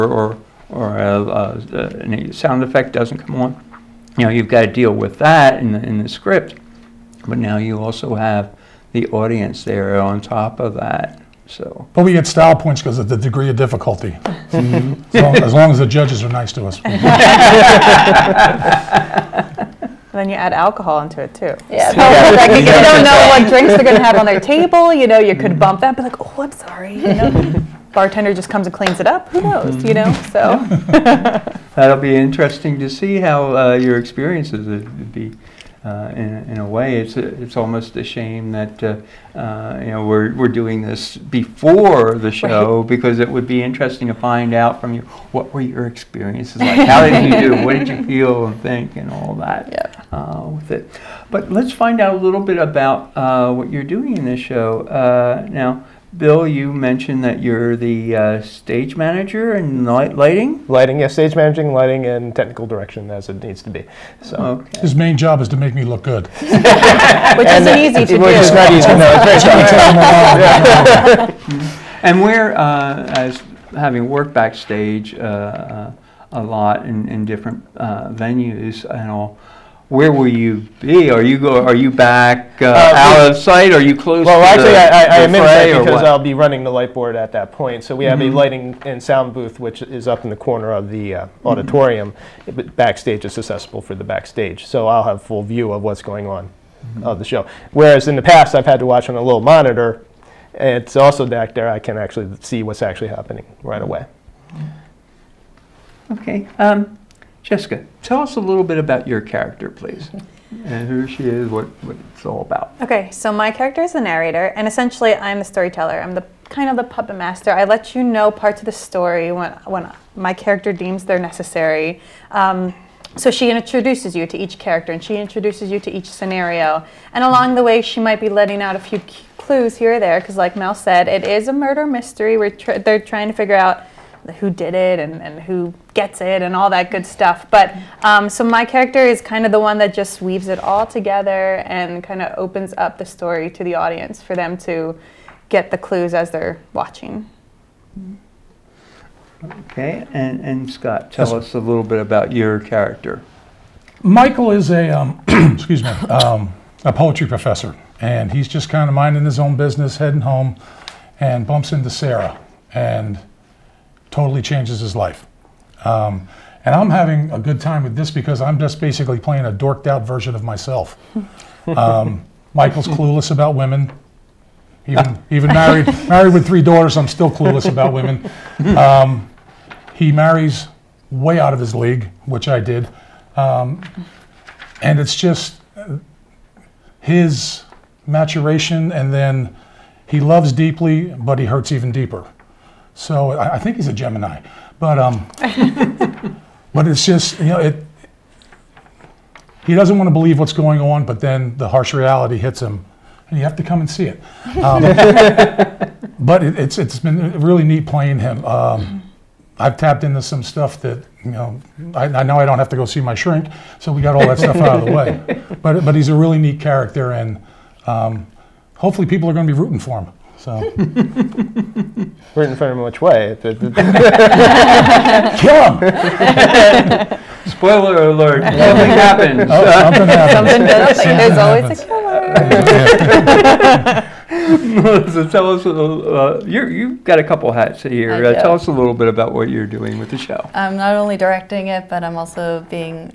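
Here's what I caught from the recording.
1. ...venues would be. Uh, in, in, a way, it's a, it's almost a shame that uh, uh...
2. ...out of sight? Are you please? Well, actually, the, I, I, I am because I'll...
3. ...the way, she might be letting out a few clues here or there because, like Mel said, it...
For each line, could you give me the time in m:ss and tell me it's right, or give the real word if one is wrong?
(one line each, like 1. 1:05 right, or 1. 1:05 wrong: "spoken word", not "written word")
1. 0:33 wrong: "experiences", not "venues"
2. 1:22 wrong: "close", not "please"
3. 2:07 right.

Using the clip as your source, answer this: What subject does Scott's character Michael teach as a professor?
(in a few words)
Poetry.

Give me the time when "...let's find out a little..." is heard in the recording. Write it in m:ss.
0:51.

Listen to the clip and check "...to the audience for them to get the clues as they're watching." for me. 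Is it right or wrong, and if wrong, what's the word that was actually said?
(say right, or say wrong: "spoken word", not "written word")
right.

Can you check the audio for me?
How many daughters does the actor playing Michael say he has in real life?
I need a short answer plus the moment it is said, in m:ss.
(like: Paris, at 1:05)
3, at 2:56.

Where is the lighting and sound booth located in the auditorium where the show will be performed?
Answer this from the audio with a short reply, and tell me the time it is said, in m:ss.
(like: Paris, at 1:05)
Up in the corner, at 1:30.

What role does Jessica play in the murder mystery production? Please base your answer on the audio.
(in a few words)
The narrator.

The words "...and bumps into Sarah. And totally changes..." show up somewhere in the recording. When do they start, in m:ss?
2:41.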